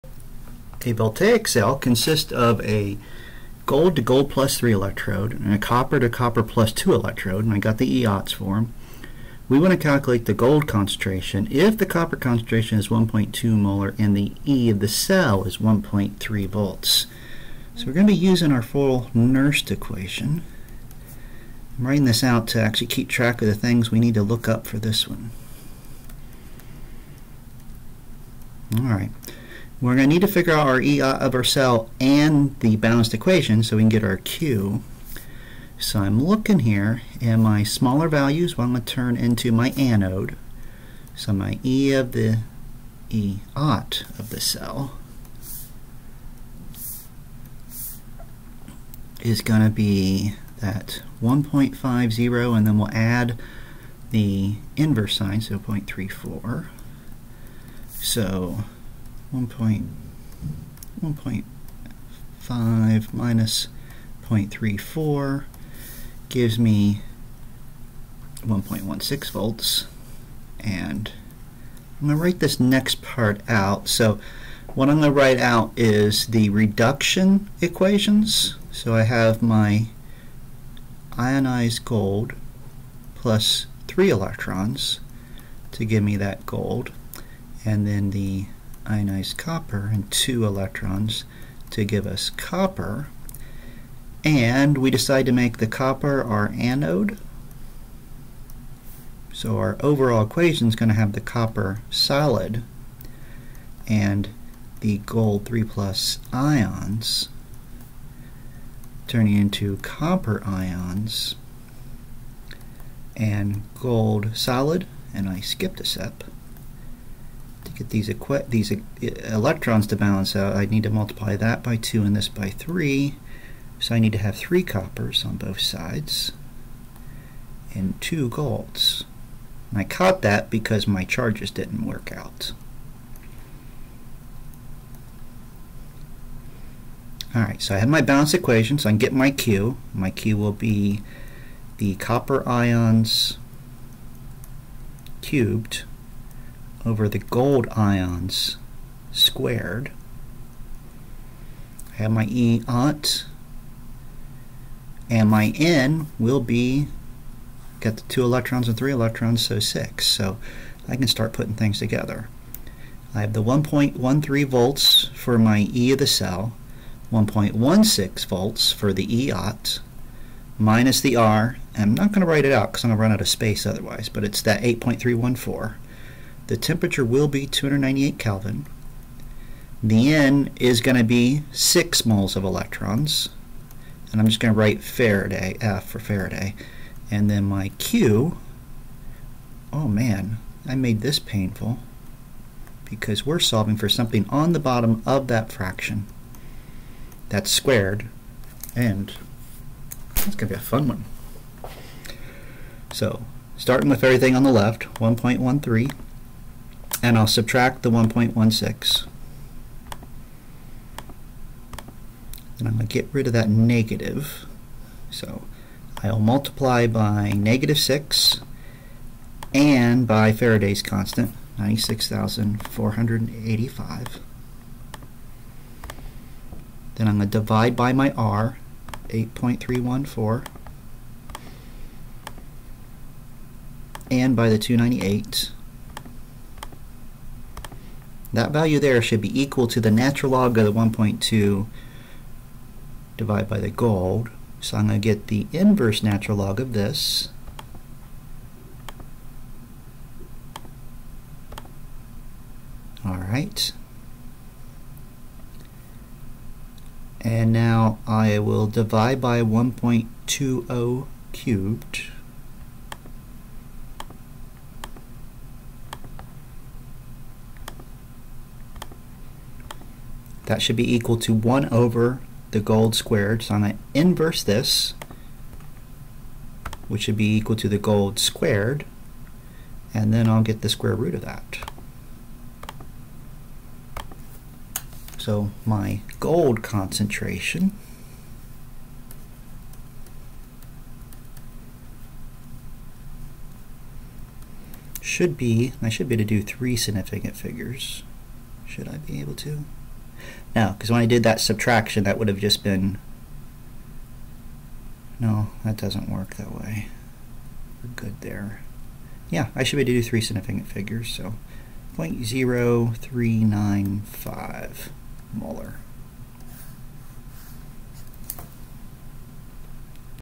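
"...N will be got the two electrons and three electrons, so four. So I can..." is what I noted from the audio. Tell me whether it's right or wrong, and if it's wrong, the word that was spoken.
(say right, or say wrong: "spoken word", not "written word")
wrong: "six", not "four".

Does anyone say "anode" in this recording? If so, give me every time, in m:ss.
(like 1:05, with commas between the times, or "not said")
0:39, 1:36.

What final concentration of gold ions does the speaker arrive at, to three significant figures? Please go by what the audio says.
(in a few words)
0.0395 molar.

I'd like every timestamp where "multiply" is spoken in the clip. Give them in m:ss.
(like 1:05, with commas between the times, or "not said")
2:00, 3:36.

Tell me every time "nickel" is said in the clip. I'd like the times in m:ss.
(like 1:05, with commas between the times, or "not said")
not said.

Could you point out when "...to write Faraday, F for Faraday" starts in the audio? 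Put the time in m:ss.
3:04.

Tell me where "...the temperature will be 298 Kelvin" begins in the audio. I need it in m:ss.
2:56.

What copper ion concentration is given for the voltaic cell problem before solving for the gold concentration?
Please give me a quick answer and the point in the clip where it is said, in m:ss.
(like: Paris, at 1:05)
1.2 molar, at 0:12.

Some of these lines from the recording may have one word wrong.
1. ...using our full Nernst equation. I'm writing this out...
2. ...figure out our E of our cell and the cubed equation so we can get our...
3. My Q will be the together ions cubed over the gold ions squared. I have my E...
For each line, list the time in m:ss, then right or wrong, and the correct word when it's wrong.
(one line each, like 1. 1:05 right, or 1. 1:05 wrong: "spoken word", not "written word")
1. 0:18 right
2. 0:30 wrong: "balanced", not "cubed"
3. 2:19 wrong: "copper", not "together".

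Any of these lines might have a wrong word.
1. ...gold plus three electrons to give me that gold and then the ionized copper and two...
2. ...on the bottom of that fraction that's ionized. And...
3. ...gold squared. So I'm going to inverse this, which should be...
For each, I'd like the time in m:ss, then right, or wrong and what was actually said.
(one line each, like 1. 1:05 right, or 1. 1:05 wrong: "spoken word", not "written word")
1. 1:21 right
2. 3:14 wrong: "squared", not "ionized"
3. 4:32 right.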